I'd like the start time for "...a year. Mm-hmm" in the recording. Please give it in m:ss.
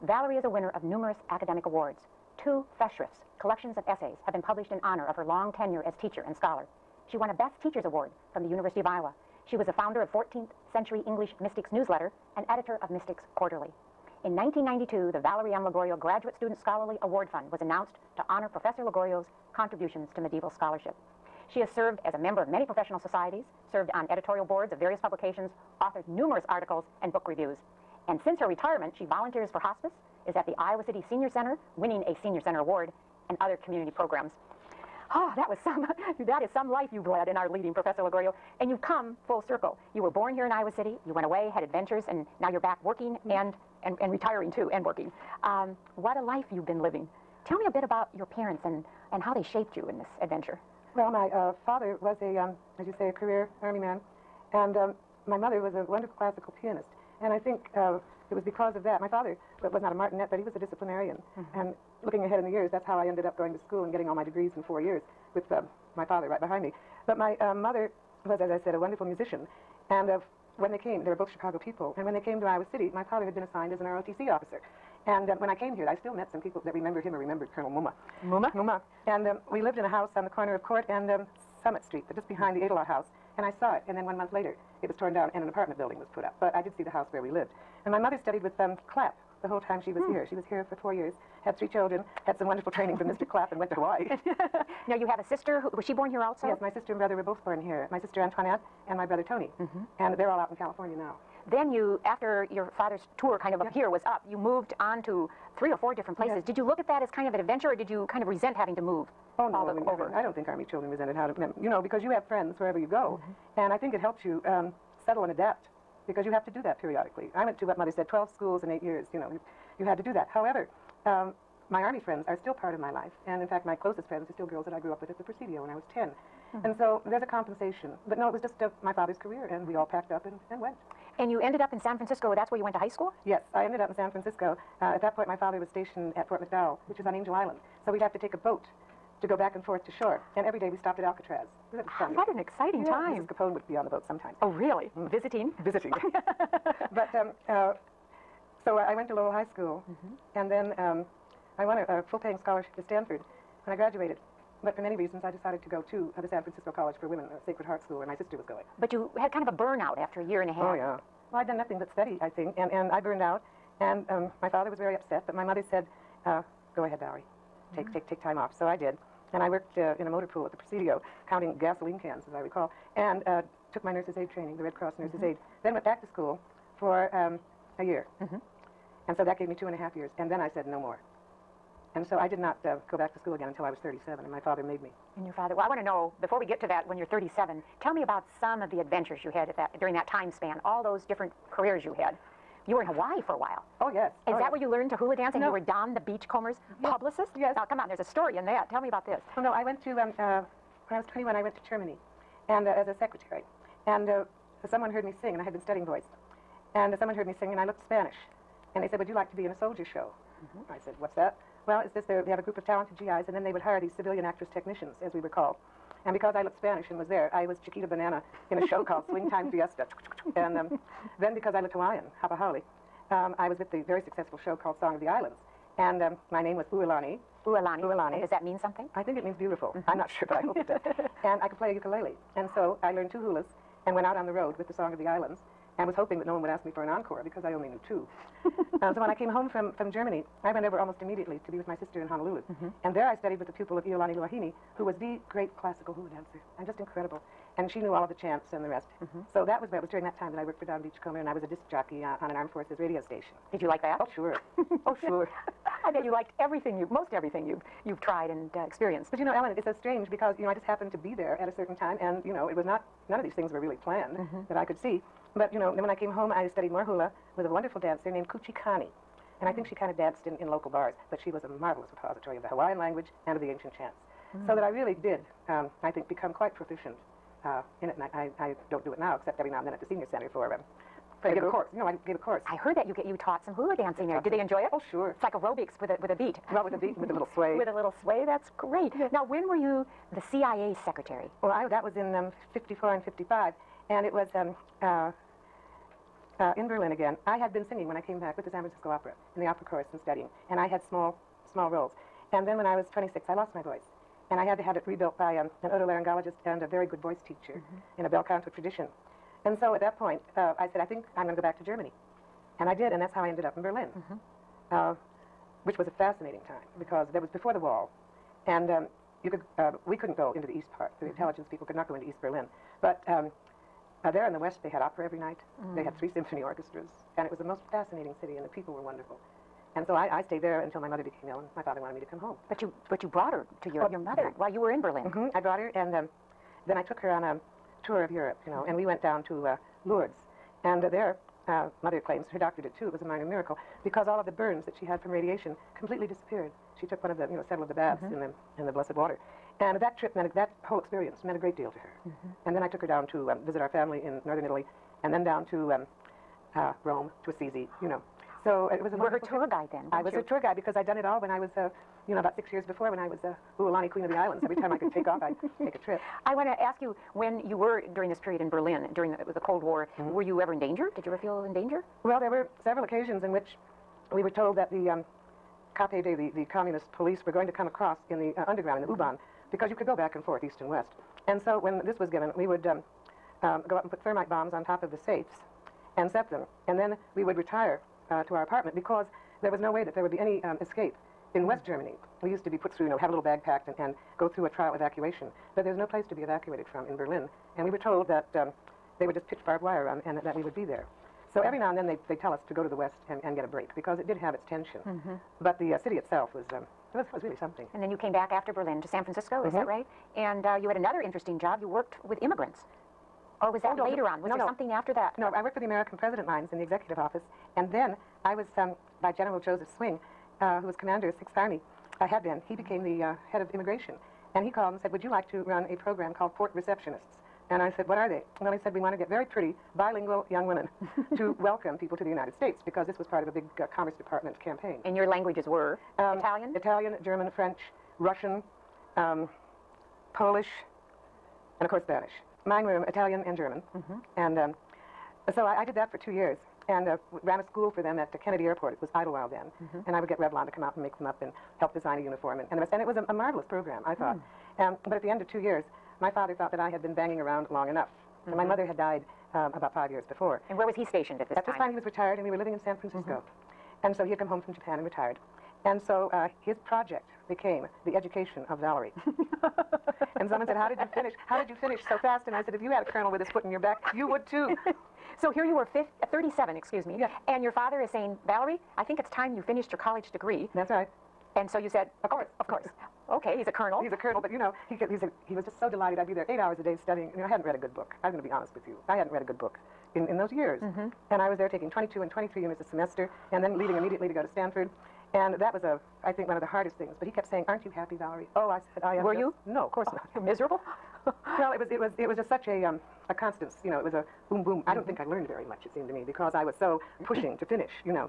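2:57.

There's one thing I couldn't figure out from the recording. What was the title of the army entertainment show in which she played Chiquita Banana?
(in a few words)
Swing Time Fiesta.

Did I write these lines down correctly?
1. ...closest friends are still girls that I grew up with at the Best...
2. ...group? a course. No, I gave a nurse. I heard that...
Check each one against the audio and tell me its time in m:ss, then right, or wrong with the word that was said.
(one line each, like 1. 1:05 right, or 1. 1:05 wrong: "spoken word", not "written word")
1. 2:03 wrong: "Presidio", not "Best"
2. 4:41 wrong: "course", not "nurse".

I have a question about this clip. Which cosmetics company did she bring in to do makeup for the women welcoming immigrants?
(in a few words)
Revlon.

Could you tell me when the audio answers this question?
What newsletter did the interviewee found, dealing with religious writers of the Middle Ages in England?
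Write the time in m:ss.
0:10.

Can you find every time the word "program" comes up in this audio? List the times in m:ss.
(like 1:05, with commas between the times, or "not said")
0:33, 7:05, 7:33.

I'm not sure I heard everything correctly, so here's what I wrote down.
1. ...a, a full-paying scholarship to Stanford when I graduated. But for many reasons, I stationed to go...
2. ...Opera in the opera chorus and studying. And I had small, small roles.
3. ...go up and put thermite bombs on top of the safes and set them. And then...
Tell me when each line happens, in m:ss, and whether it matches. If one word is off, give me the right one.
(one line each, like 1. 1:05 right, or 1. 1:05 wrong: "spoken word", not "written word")
1. 2:31 wrong: "decided", not "stationed"
2. 4:58 right
3. 6:23 right.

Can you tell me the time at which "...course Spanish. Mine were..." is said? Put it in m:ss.
7:21.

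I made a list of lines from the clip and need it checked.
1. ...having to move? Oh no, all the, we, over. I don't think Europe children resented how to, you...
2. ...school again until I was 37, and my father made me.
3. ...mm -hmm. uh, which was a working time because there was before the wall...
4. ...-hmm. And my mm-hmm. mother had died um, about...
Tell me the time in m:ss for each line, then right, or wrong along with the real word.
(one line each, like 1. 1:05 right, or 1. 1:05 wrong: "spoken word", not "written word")
1. 1:48 wrong: "Army", not "Europe"
2. 3:03 right
3. 5:13 wrong: "fascinating", not "working"
4. 7:38 right.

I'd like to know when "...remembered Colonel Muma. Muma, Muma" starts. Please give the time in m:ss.
1:17.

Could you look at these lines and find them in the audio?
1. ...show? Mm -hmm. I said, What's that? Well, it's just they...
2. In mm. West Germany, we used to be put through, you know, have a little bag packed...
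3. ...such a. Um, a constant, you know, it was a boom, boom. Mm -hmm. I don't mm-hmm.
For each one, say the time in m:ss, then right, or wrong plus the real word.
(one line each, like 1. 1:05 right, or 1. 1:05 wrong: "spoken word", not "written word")
1. 3:29 right
2. 6:31 right
3. 8:22 right.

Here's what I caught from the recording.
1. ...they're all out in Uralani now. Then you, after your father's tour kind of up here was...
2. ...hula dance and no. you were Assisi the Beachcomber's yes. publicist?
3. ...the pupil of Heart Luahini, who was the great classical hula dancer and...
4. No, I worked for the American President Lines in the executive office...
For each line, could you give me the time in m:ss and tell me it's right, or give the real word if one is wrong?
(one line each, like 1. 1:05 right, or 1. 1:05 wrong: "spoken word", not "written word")
1. 1:40 wrong: "California", not "Uralani"
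2. 3:14 wrong: "Don", not "Assisi"
3. 4:03 wrong: "Iolani", not "Heart"
4. 6:55 right.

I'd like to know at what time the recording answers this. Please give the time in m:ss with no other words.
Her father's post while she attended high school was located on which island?
2:17.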